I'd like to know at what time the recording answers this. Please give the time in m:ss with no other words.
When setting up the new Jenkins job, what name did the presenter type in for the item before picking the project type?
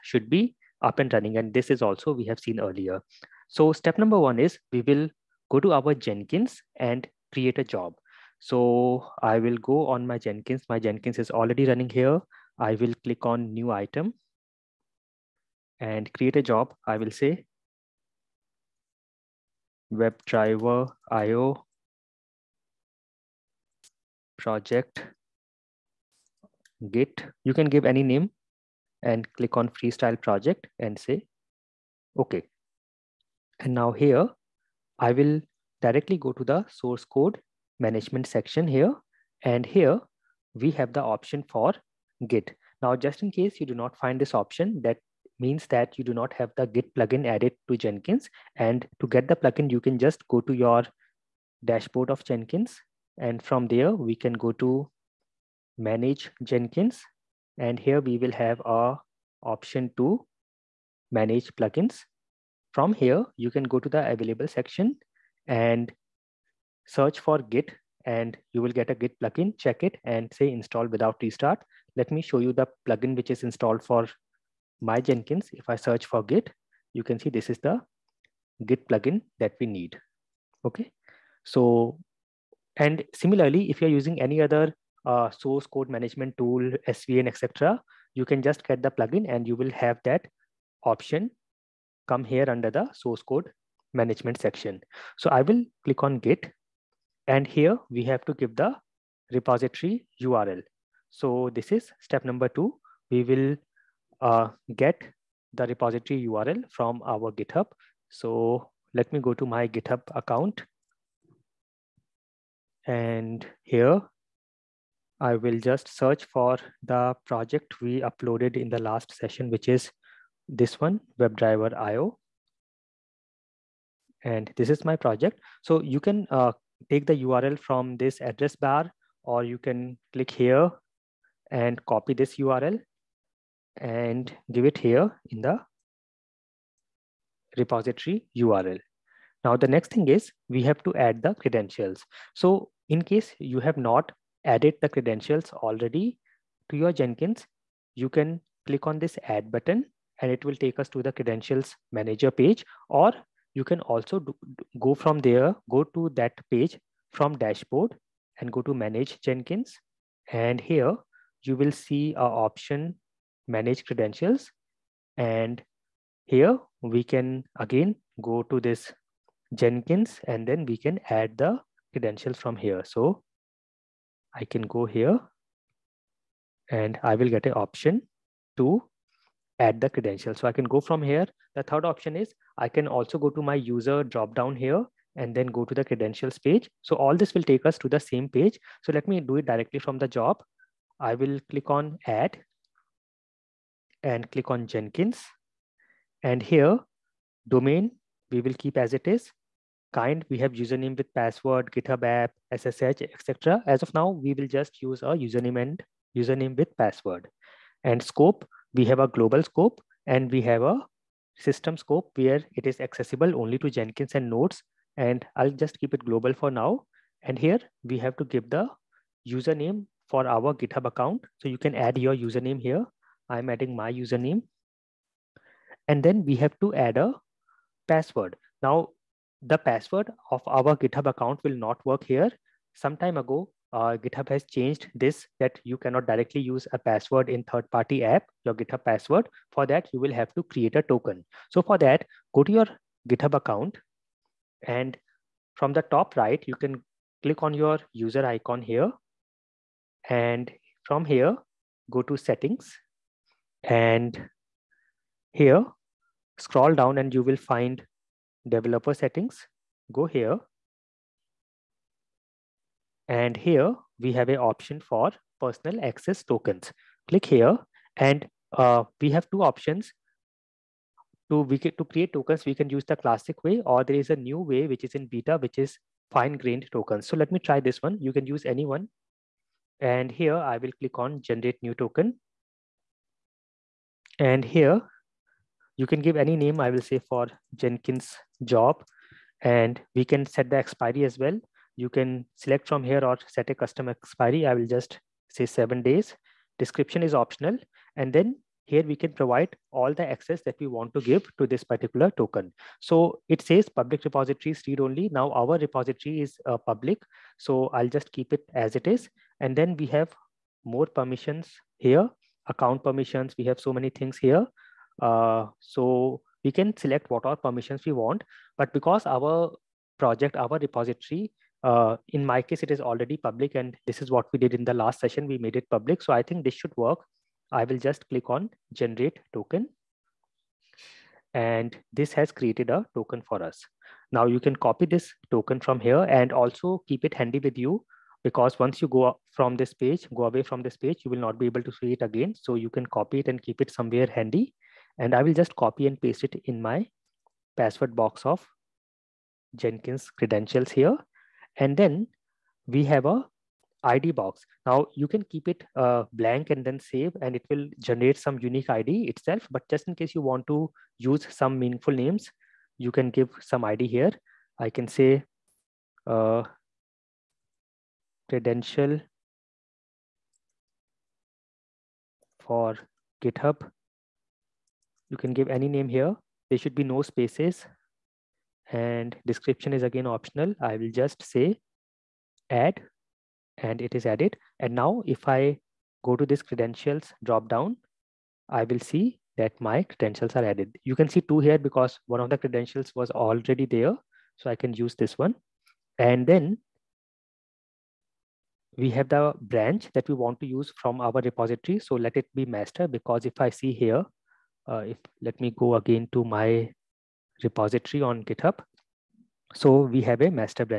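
0:19.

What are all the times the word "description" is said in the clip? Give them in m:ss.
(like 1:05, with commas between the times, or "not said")
4:56, 6:19.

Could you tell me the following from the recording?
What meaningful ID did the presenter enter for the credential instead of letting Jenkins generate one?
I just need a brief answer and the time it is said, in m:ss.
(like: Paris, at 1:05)
credential for GitHub, at 6:08.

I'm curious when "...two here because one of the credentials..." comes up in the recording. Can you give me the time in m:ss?
6:31.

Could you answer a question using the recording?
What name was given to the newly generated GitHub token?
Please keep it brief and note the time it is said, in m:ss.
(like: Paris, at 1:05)
for Jenkins job, at 4:46.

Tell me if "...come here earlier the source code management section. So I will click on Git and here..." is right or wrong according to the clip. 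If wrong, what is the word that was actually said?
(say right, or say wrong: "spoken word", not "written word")
wrong: "under", not "earlier".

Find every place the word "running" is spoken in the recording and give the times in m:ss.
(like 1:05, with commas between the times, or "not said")
0:01, 0:11.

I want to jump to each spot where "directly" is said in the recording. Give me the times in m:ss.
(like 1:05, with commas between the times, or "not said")
0:35, 3:09, 3:56.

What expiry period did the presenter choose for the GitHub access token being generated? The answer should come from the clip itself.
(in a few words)
7 days.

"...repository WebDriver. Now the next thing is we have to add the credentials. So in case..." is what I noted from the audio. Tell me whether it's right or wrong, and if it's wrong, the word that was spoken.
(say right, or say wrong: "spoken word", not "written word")
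wrong: "URL", not "WebDriver".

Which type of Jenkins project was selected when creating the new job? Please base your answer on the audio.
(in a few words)
Freestyle project.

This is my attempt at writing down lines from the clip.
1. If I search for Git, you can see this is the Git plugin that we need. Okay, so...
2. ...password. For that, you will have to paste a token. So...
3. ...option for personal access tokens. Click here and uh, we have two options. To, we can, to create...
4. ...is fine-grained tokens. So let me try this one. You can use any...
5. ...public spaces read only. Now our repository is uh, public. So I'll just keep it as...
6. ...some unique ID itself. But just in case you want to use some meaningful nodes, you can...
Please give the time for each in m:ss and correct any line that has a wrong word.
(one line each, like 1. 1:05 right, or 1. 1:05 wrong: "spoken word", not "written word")
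1. 1:15 right
2. 3:58 wrong: "create", not "paste"
3. 4:24 right
4. 4:35 right
5. 5:03 wrong: "repositories", not "spaces"
6. 5:58 wrong: "names", not "nodes".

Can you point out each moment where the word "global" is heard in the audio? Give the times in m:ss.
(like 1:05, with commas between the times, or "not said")
3:29, 3:36.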